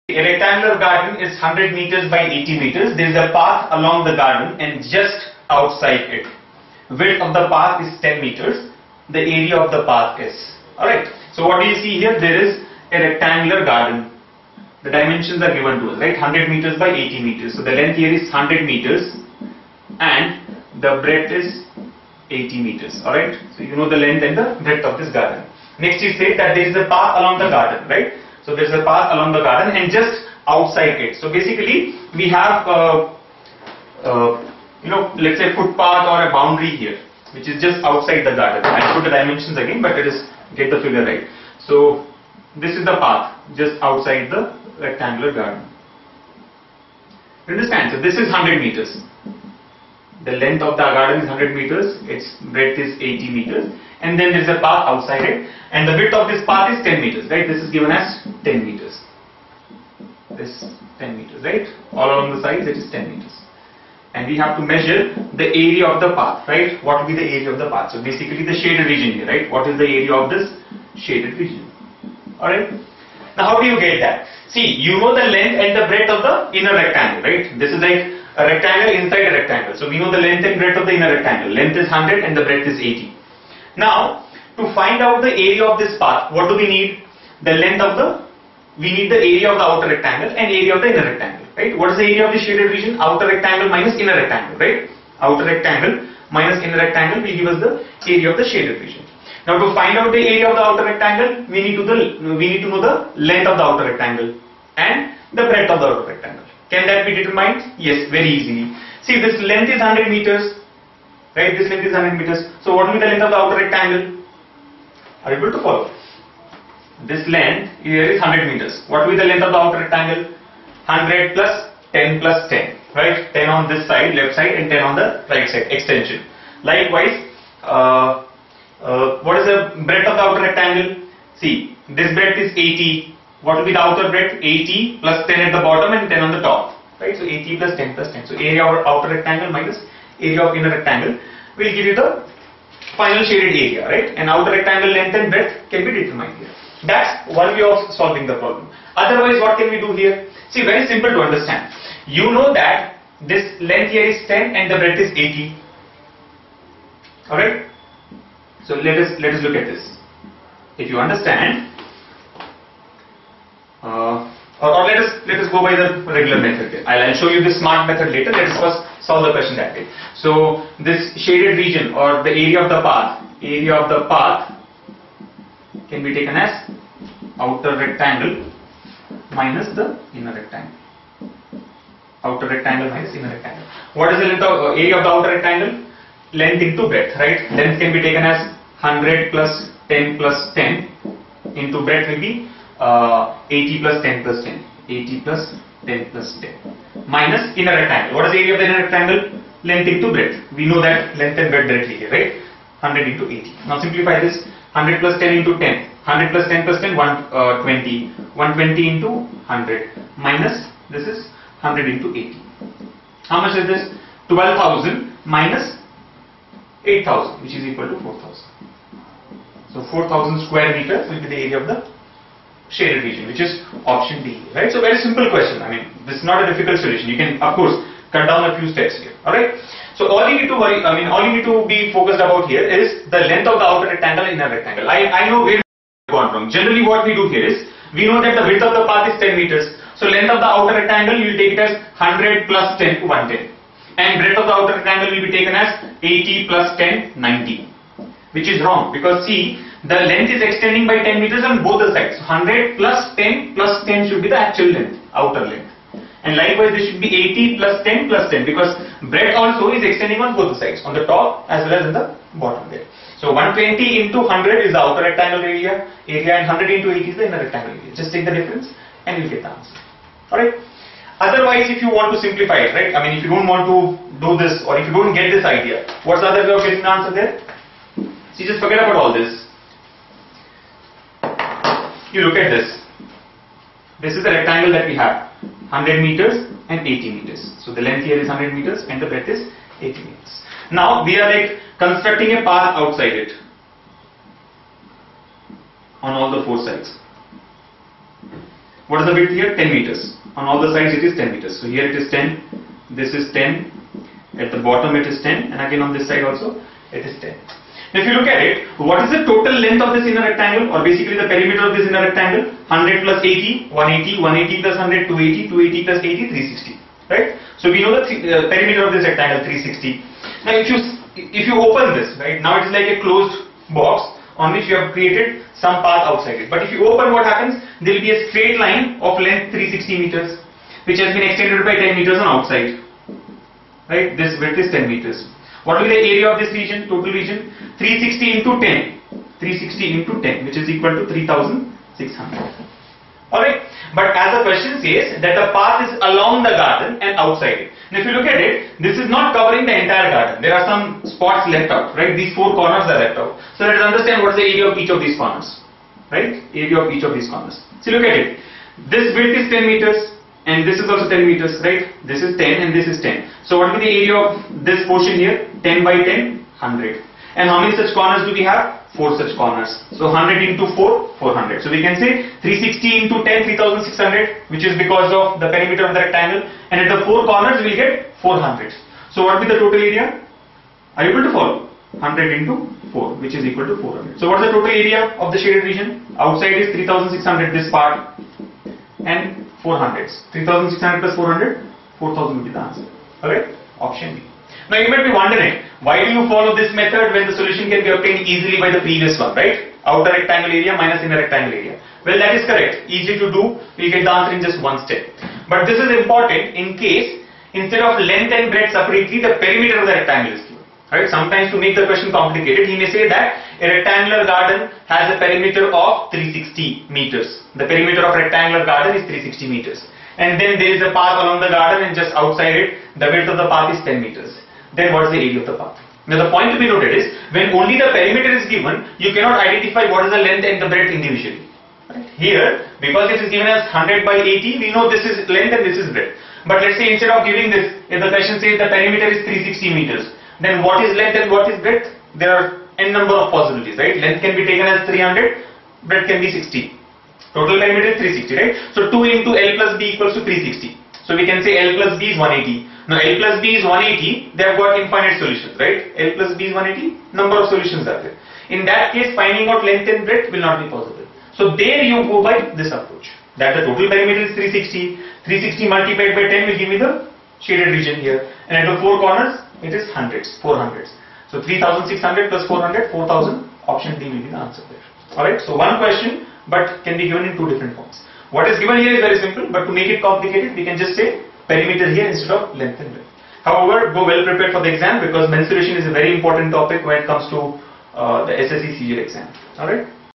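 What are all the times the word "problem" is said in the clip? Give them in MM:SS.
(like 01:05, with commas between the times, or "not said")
02:28.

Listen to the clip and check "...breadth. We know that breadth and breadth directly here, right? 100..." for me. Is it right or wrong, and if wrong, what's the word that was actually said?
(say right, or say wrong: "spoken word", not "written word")
wrong: "length", not "breadth".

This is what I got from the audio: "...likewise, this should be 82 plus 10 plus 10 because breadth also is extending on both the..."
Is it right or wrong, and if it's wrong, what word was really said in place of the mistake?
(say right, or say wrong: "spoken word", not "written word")
wrong: "80", not "82".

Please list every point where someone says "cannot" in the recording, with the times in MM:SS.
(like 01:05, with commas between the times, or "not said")
07:09.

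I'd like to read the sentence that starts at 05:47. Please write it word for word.
And if you look at it, this is not covering the entire garden.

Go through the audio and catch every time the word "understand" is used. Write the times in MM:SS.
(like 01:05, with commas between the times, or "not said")
00:47, 02:31, 02:40, 05:53.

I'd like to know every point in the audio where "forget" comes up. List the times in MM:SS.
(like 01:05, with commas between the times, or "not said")
04:38.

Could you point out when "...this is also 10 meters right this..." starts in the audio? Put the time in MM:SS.
06:00.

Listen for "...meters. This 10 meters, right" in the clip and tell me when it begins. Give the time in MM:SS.
00:58.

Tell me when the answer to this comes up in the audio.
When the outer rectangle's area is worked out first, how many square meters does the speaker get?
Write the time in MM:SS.
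03:34.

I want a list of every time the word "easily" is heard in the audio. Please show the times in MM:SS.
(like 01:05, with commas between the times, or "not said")
01:48, 06:38.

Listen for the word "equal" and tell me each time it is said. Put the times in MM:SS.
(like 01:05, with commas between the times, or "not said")
03:37, 05:40, 06:23, 07:29.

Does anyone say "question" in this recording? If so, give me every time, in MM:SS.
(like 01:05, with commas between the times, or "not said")
02:49, 03:45, 05:44, 06:51, 07:18, 07:55.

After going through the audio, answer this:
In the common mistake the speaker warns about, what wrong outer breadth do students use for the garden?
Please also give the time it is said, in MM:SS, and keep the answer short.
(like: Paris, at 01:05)
90, at 04:06.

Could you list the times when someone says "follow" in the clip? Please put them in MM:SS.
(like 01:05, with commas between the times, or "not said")
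01:55, 06:21, 06:36.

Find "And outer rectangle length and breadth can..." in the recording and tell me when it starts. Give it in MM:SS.
02:24.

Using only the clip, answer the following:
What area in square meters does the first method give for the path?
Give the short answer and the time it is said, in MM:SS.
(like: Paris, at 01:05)
4,000, option D, at 03:39.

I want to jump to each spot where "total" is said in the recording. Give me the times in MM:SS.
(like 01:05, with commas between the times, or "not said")
05:09, 05:36, 06:19, 06:24, 07:27, 07:43.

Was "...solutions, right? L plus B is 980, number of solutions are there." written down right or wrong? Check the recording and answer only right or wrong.
wrong.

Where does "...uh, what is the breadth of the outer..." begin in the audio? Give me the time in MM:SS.
02:08.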